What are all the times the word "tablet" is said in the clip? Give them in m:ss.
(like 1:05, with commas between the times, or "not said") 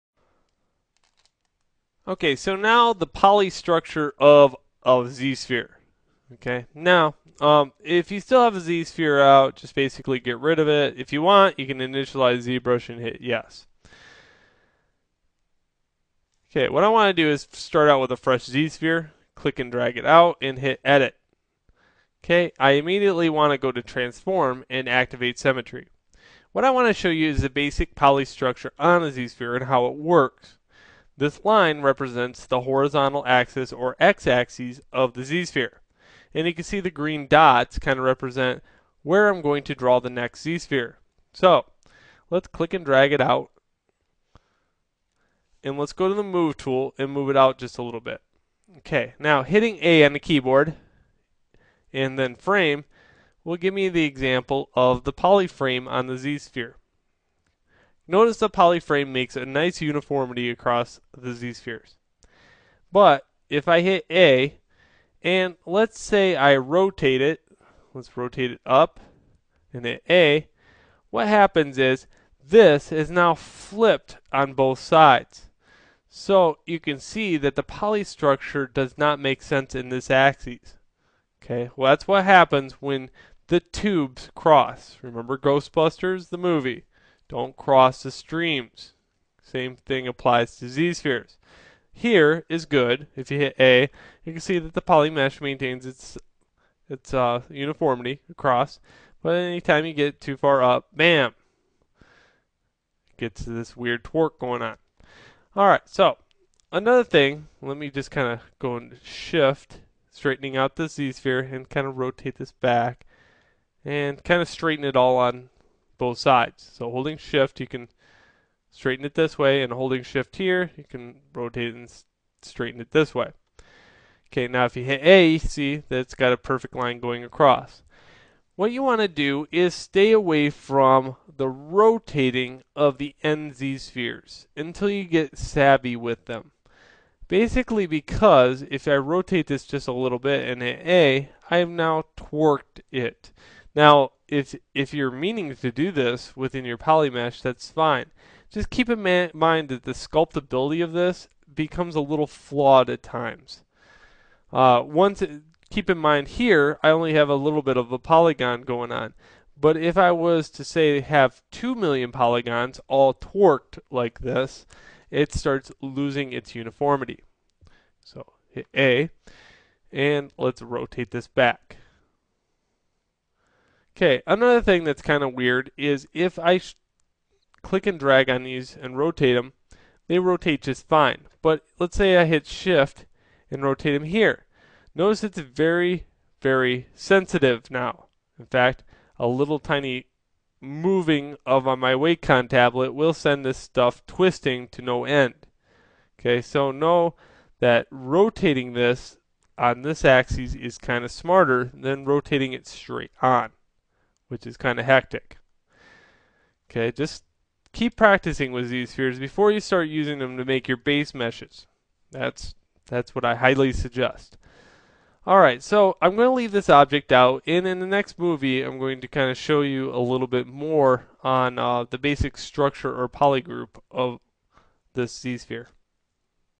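3:12.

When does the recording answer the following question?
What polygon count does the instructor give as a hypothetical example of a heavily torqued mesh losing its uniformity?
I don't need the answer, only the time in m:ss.
2:41.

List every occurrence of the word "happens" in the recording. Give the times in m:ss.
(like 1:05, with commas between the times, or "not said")
1:11, 1:22.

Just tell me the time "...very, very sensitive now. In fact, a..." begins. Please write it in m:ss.
3:05.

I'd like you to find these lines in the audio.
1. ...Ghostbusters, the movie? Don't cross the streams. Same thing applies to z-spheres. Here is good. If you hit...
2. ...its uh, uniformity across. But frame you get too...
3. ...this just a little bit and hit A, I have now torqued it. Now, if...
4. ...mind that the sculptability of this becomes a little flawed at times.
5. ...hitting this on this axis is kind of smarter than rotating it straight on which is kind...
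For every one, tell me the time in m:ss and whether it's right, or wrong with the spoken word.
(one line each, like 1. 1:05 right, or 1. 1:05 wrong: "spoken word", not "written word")
1. 1:25 right
2. 1:36 wrong: "anytime", not "frame"
3. 2:19 right
4. 2:29 right
5. 3:17 wrong: "rotating", not "hitting".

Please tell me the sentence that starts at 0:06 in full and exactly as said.
Okay, now um, if you still have a z-sphere out, just basically get rid of it.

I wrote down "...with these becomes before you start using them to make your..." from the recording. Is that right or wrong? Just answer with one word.
wrong.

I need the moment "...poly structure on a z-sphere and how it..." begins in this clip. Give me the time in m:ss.
0:27.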